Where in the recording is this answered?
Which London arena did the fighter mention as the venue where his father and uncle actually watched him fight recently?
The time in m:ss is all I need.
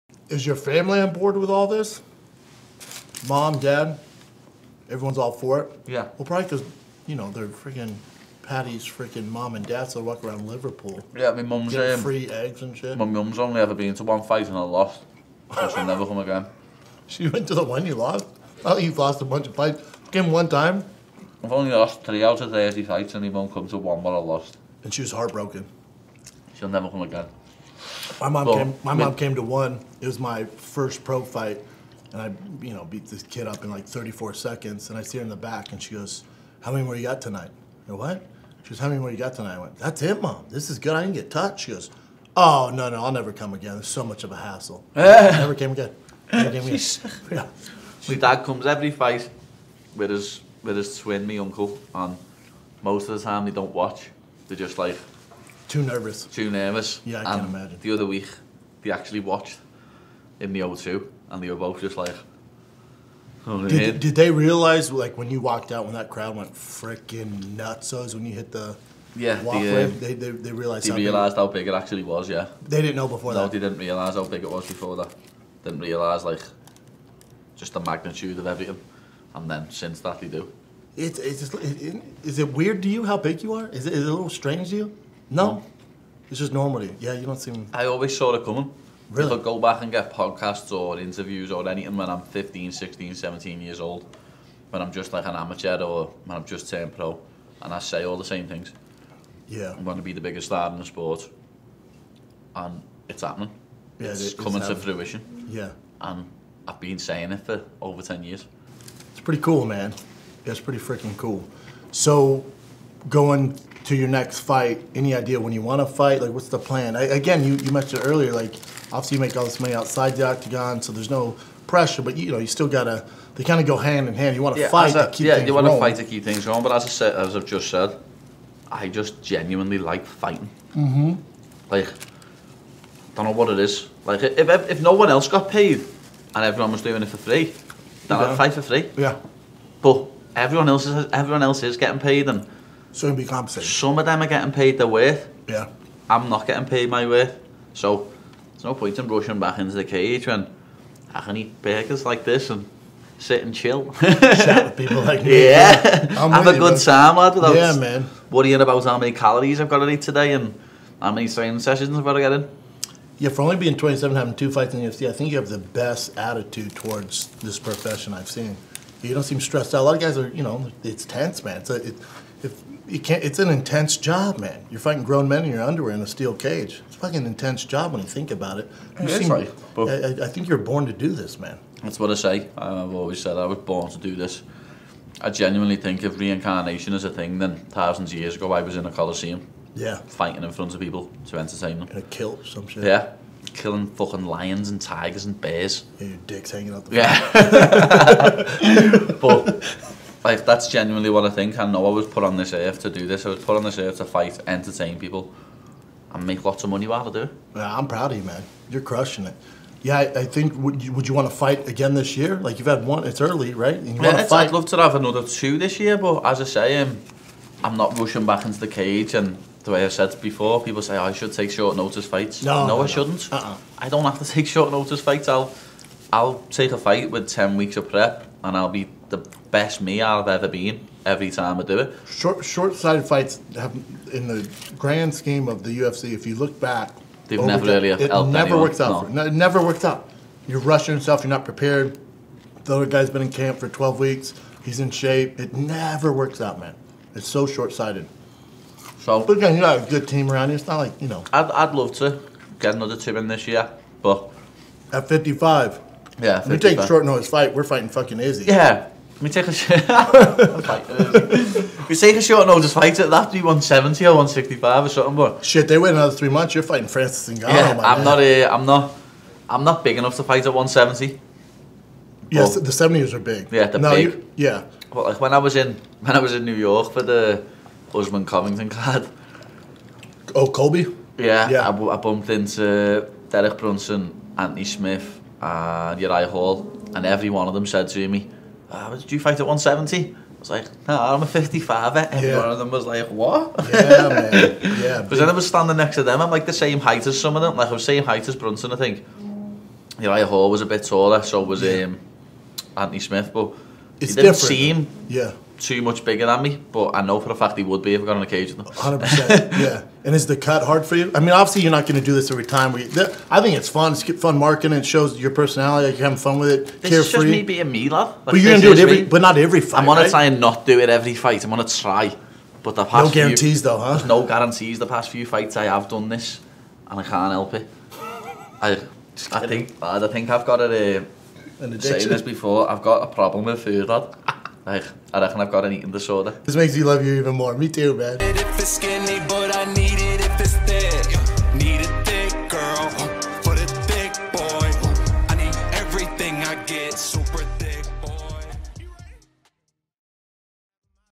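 1:00.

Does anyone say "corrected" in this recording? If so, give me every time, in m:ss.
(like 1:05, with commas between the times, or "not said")
not said.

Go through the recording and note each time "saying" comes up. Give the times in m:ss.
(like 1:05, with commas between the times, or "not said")
1:46, 5:31.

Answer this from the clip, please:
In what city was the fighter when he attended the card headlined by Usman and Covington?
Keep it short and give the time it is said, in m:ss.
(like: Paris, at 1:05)
New York, at 4:36.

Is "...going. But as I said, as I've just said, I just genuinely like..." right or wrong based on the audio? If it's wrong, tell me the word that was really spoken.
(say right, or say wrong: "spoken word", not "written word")
right.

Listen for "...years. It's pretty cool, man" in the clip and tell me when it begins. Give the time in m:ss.
1:48.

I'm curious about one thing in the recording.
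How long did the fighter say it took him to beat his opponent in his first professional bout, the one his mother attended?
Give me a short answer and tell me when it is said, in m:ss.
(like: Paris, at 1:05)
34 seconds, at 0:33.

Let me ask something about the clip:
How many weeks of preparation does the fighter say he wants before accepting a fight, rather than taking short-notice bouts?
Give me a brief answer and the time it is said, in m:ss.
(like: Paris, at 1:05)
10 weeks, at 3:47.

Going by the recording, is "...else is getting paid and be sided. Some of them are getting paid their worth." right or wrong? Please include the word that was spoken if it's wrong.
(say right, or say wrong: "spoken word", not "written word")
wrong: "compensated", not "sided".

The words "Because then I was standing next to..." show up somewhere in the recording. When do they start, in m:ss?
4:55.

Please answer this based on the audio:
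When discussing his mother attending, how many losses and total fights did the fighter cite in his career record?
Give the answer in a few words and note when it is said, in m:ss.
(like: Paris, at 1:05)
3 out of 30, at 0:22.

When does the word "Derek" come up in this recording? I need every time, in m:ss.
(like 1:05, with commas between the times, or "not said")
4:43.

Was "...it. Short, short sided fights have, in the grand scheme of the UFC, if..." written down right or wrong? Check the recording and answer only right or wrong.
right.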